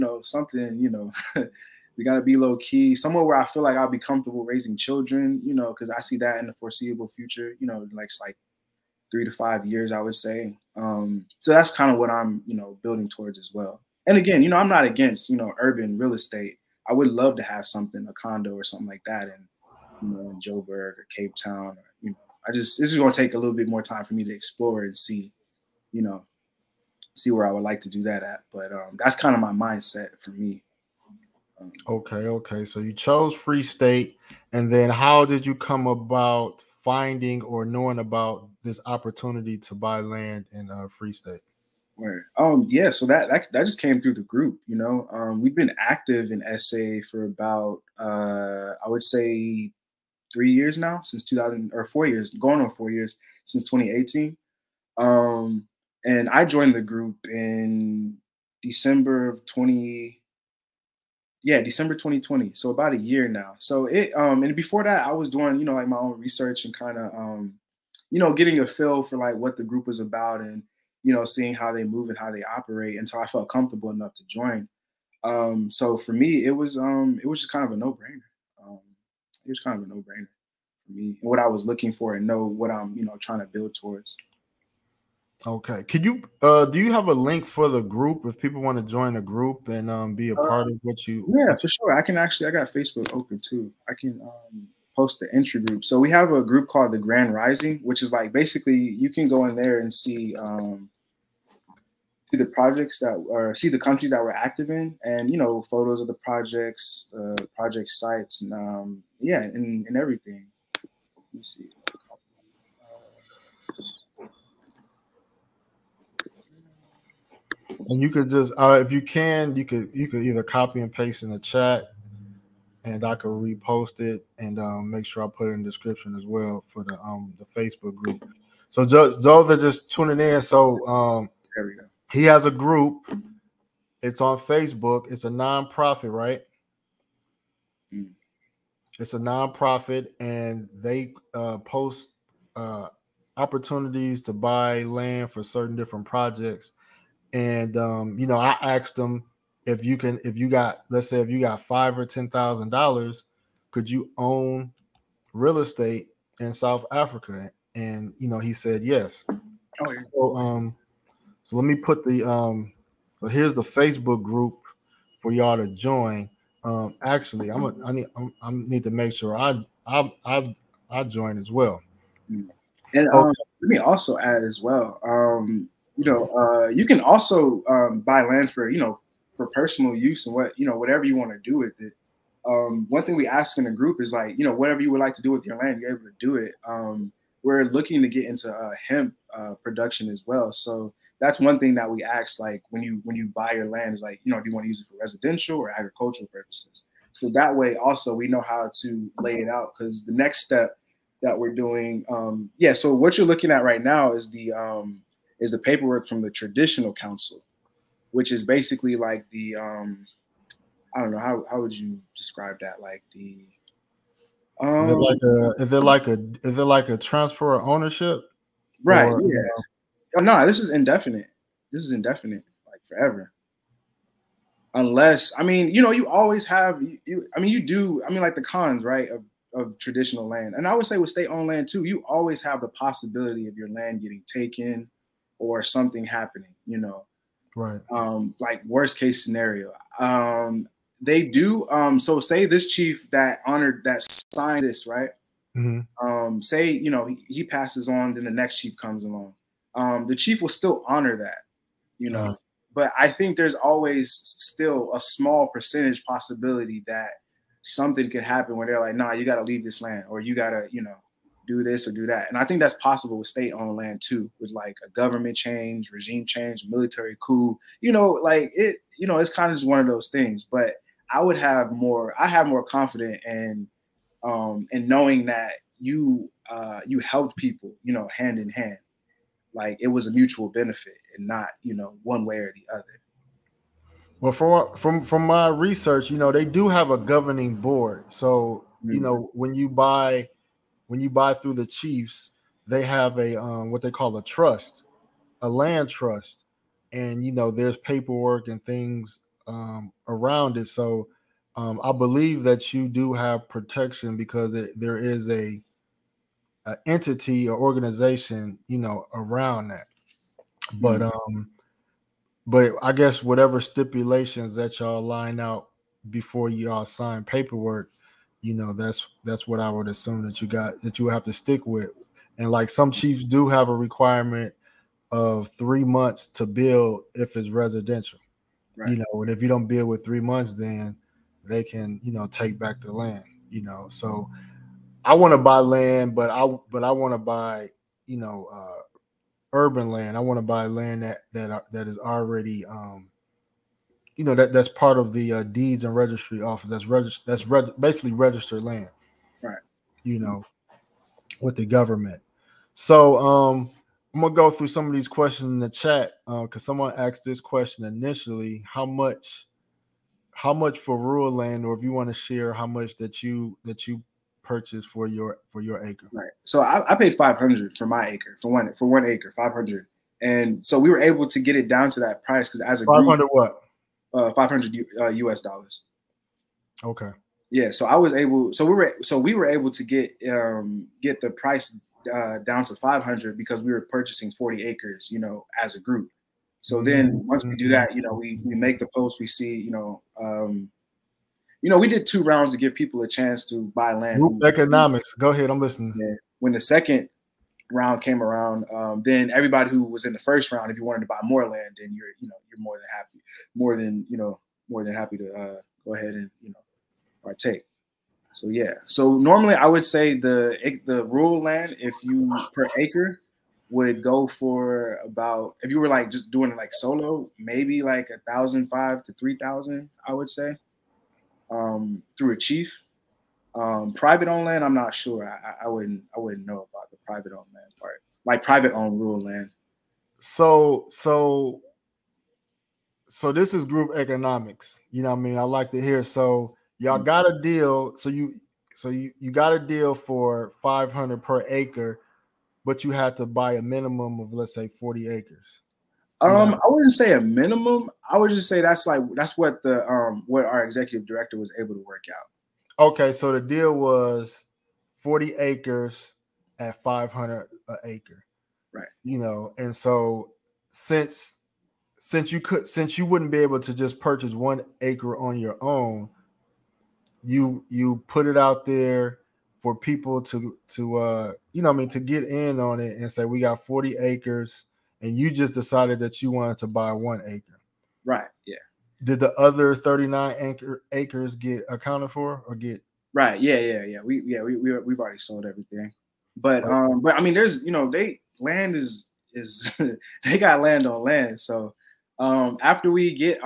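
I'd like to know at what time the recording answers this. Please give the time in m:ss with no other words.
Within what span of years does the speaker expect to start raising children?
0:09.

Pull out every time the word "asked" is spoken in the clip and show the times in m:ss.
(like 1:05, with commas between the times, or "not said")
2:28, 5:56.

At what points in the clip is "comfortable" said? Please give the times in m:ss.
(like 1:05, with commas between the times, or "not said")
0:03, 1:13.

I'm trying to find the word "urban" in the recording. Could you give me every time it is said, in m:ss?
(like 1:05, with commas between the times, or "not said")
0:15, 5:39.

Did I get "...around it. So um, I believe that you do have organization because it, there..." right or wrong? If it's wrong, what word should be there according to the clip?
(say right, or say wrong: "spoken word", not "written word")
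wrong: "protection", not "organization".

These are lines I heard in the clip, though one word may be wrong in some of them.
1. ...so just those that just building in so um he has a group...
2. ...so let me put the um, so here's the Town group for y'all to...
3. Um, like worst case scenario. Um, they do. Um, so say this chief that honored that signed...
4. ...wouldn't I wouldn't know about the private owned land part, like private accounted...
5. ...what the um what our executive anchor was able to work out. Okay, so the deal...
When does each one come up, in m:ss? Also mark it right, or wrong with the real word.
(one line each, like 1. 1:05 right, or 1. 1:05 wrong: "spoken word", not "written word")
1. 2:08 wrong: "tuning", not "building"
2. 2:41 wrong: "Facebook", not "Town"
3. 3:57 right
4. 7:05 wrong: "owned", not "accounted"
5. 7:29 wrong: "director", not "anchor".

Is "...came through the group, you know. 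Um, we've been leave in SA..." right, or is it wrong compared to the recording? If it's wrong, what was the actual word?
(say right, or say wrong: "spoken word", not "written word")
wrong: "active", not "leave".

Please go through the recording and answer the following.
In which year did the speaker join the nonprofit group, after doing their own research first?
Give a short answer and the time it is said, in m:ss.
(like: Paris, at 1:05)
2020, at 1:01.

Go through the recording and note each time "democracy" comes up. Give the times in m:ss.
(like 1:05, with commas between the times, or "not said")
not said.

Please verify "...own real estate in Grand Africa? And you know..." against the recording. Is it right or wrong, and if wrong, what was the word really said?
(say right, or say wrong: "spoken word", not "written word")
wrong: "South", not "Grand".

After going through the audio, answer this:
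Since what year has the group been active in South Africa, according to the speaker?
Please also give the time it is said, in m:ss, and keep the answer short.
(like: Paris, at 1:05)
2018, at 0:53.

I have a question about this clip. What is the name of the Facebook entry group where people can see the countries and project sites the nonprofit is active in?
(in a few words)
The Grand Rising.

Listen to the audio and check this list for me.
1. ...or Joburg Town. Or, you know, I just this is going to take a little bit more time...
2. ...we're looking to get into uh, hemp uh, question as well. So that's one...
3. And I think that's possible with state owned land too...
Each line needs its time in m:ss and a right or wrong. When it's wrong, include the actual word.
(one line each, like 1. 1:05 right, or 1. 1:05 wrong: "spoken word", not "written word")
1. 0:20 wrong: "Cape", not "Joburg"
2. 3:07 wrong: "production", not "question"
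3. 4:22 right.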